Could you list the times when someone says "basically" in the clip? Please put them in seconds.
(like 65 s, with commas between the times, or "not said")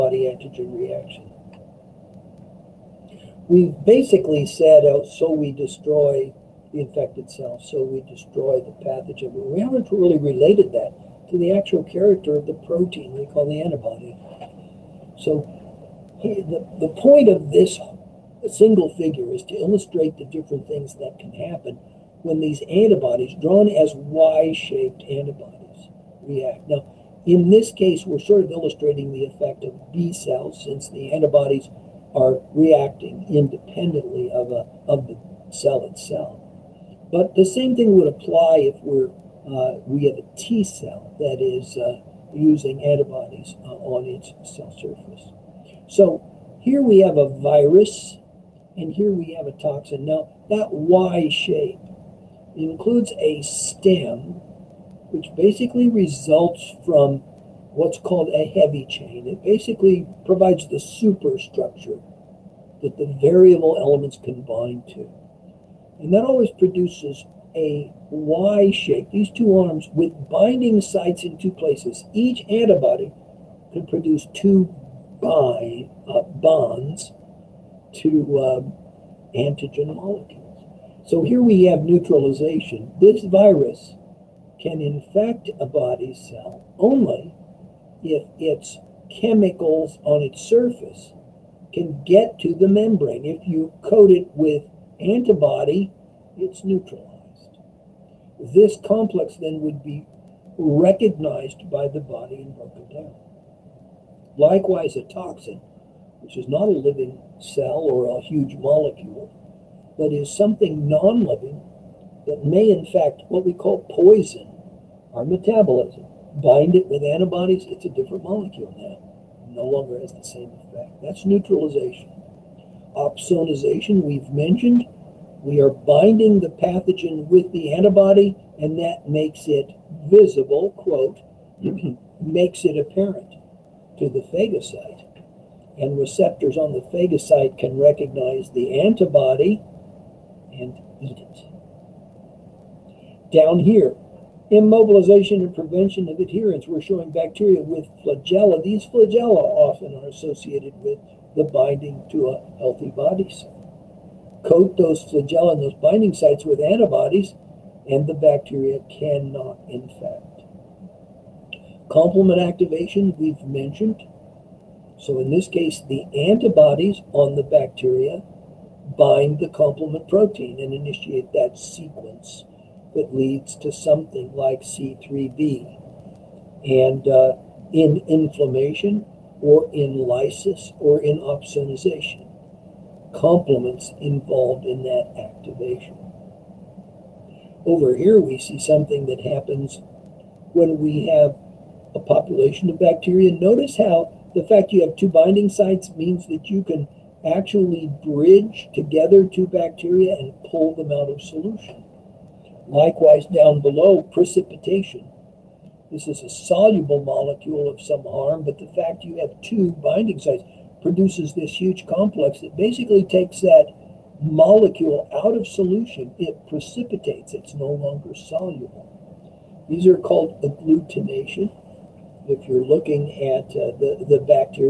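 3 s, 55 s, 59 s, 212 s.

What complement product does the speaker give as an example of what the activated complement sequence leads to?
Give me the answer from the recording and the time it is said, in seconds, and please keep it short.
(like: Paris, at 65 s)
C3b, at 174 s.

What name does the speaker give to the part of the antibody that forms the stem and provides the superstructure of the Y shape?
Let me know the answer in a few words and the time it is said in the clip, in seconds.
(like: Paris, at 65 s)
heavy chain, at 58 s.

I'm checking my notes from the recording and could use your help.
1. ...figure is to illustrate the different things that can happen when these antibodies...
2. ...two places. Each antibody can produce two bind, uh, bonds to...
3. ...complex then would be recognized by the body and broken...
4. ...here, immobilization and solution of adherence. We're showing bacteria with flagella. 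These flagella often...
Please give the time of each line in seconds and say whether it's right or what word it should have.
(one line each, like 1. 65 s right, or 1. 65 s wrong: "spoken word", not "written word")
1. 18 s right
2. 71 s right
3. 98 s right
4. 143 s wrong: "prevention", not "solution".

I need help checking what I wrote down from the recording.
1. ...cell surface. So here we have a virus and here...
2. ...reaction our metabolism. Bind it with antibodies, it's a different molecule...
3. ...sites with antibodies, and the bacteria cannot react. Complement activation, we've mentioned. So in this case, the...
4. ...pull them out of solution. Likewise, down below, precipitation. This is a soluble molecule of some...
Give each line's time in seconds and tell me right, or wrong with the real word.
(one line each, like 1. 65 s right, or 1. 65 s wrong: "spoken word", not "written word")
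1. 44 s right
2. 113 s wrong: "poison", not "reaction"
3. 156 s wrong: "infect", not "react"
4. 200 s right.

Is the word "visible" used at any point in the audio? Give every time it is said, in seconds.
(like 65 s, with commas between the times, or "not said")
130 s.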